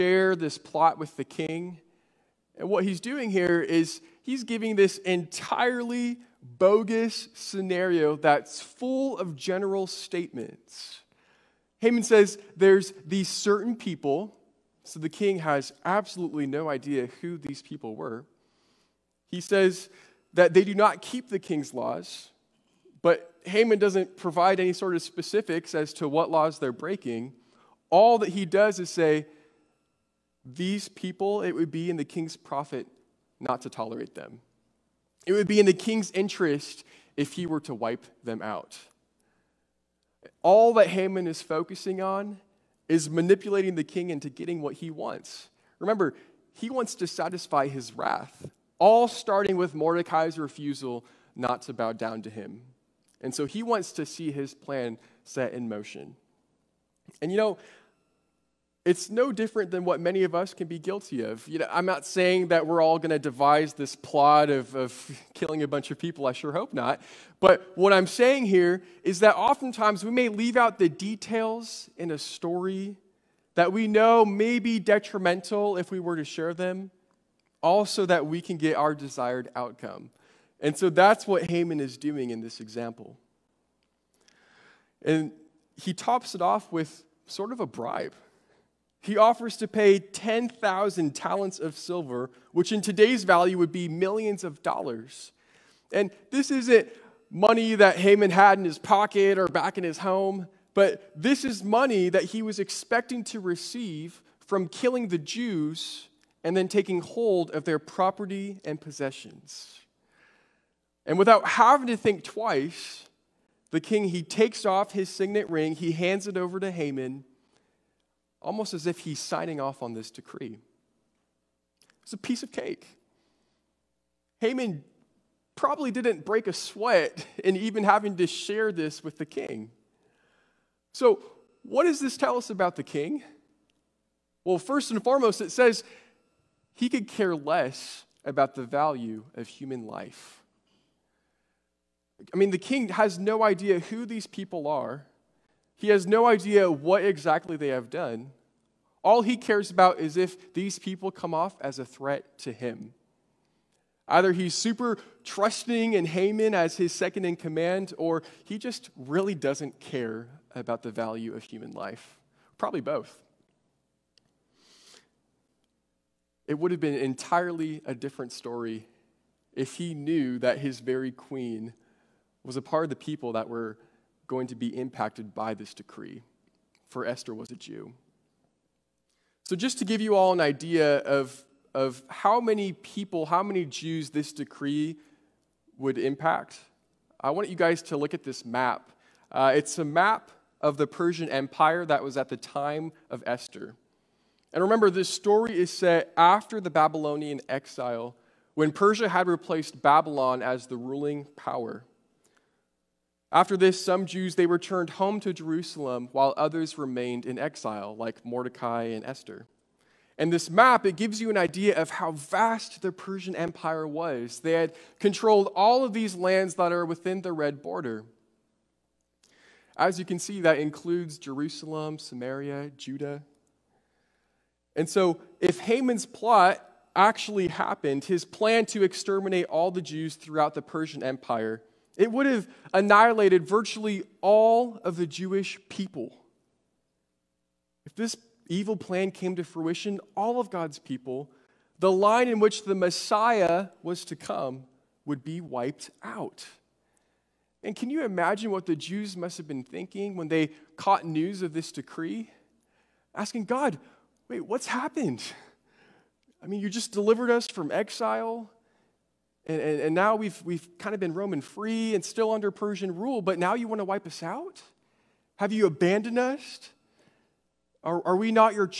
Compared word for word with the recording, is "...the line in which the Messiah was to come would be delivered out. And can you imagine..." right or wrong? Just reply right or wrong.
wrong.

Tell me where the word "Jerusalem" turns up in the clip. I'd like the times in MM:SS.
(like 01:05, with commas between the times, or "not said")
03:25, 03:41.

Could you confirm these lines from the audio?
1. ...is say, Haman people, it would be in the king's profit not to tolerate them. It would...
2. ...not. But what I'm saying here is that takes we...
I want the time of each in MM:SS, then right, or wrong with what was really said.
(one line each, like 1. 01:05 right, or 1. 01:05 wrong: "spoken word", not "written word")
1. 00:28 wrong: "These", not "Haman"
2. 01:06 wrong: "oftentimes", not "takes".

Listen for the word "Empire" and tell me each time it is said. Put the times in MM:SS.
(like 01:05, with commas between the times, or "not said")
03:11, 03:33, 03:51.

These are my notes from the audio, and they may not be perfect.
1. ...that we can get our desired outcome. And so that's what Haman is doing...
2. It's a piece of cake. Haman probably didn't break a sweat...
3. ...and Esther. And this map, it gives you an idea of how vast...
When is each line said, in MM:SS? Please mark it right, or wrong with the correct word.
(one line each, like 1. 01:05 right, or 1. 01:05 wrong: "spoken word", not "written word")
1. 01:18 right
2. 02:02 right
3. 03:28 right.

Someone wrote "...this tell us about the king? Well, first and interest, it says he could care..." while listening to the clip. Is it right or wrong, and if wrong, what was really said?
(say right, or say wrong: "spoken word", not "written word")
wrong: "foremost", not "interest".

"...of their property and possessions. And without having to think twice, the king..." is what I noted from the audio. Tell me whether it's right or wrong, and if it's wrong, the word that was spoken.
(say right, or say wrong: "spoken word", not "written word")
right.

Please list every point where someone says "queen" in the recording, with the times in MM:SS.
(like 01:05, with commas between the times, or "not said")
02:51.